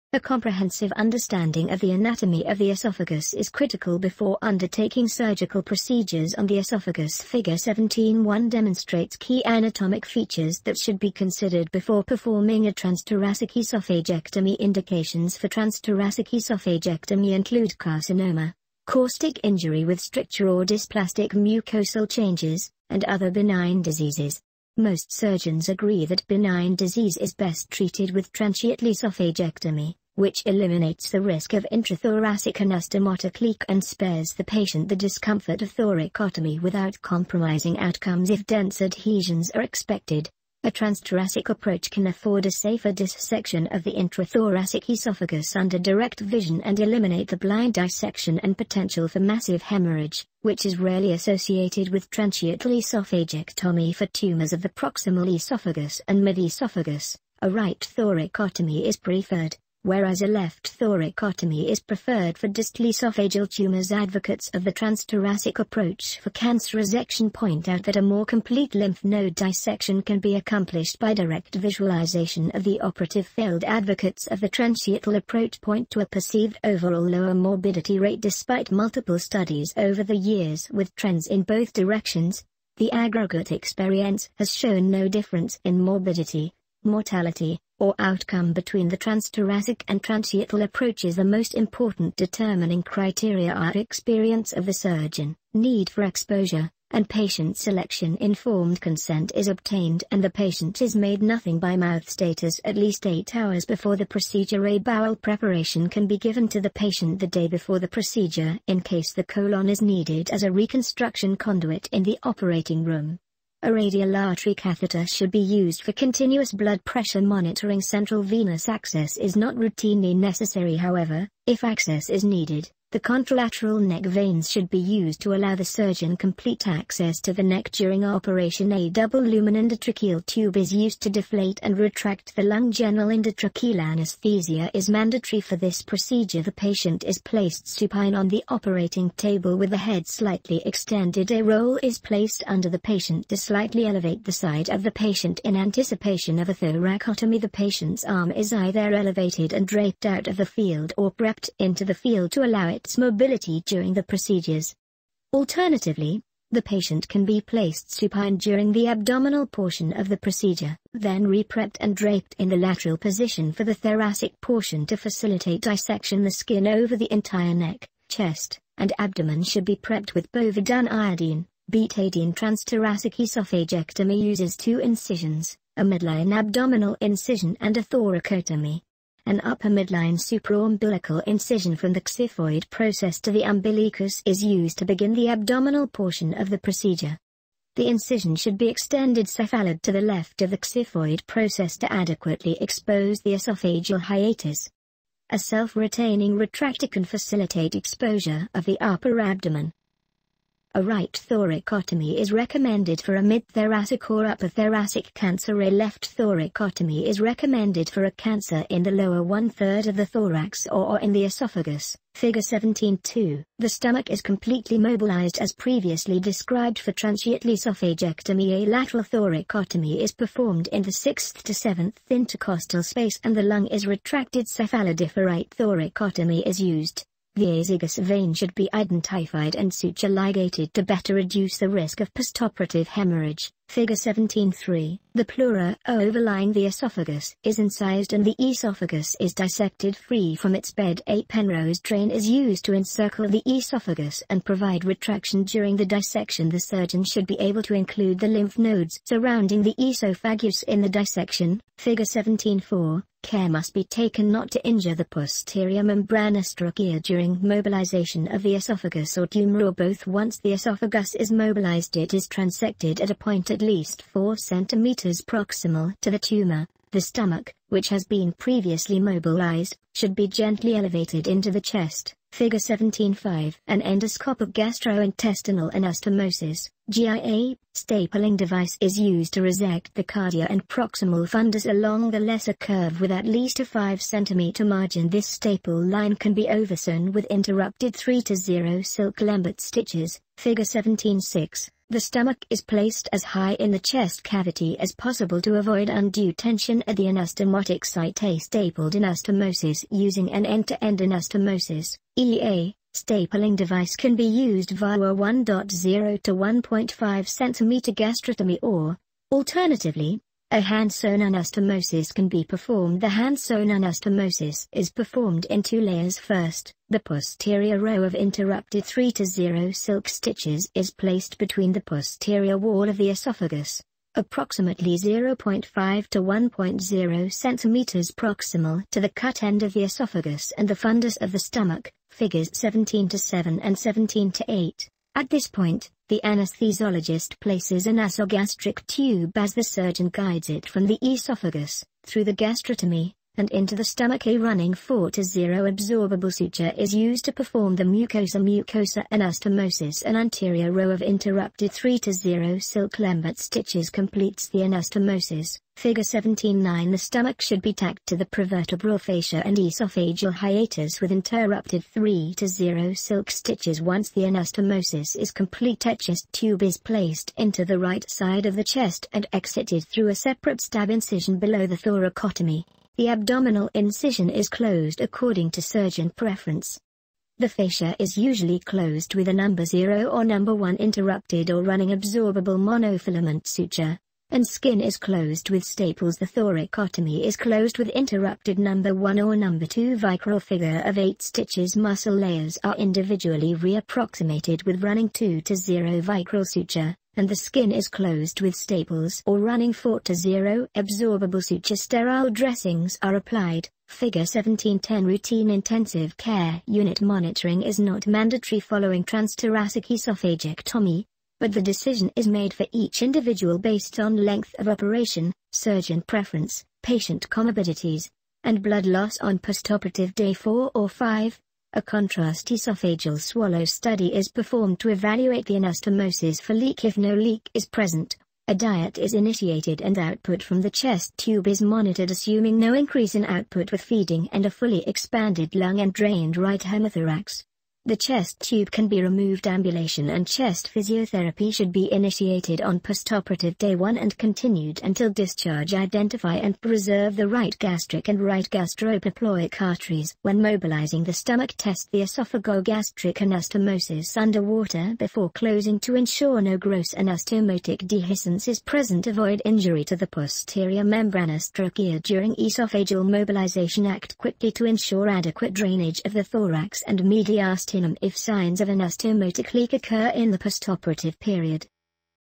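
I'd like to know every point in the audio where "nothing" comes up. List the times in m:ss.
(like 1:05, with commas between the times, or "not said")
1:41.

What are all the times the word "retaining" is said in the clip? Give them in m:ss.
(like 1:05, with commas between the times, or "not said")
3:15.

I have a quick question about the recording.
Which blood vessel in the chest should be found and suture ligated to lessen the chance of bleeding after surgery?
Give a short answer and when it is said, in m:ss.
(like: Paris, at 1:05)
azygous vein, at 3:47.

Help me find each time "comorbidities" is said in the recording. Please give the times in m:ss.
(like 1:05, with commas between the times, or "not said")
6:57.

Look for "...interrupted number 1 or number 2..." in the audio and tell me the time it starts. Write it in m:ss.
6:27.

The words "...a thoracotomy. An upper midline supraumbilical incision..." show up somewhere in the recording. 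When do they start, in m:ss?
2:57.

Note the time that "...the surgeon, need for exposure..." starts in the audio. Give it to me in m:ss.
1:34.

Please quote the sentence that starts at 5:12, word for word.
The hand sewn anastomosis is performed in two layers.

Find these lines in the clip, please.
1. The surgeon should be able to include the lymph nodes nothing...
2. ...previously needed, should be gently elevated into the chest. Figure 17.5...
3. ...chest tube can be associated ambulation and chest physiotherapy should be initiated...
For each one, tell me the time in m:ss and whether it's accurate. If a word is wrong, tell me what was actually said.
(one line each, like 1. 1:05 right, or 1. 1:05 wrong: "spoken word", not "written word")
1. 4:06 wrong: "surrounding", not "nothing"
2. 4:28 wrong: "mobilized", not "needed"
3. 7:17 wrong: "removed", not "associated".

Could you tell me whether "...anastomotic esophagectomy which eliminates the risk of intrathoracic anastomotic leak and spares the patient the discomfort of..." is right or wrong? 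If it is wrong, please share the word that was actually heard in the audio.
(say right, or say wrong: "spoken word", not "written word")
wrong: "transthoracic", not "anastomotic".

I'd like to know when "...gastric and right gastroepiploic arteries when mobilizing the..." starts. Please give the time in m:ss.
7:27.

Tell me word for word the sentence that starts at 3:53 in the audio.
Figure 17.3 The pleura overlying the esophagus is incised and the esophagus is dissected free from its bed.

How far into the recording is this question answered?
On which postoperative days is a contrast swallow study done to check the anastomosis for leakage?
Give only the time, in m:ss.
7:00.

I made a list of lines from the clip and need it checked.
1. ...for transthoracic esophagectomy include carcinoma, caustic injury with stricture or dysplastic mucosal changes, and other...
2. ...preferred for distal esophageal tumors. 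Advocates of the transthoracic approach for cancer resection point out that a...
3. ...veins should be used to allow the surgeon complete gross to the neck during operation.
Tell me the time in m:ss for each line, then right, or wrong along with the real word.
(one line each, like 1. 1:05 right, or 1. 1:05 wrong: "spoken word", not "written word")
1. 0:15 right
2. 1:01 right
3. 2:04 wrong: "access", not "gross".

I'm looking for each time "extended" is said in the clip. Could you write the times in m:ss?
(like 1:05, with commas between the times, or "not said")
2:20, 3:08.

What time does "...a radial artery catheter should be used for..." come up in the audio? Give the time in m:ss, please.
1:53.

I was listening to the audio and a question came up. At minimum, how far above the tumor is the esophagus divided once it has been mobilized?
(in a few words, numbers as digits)
4 cm.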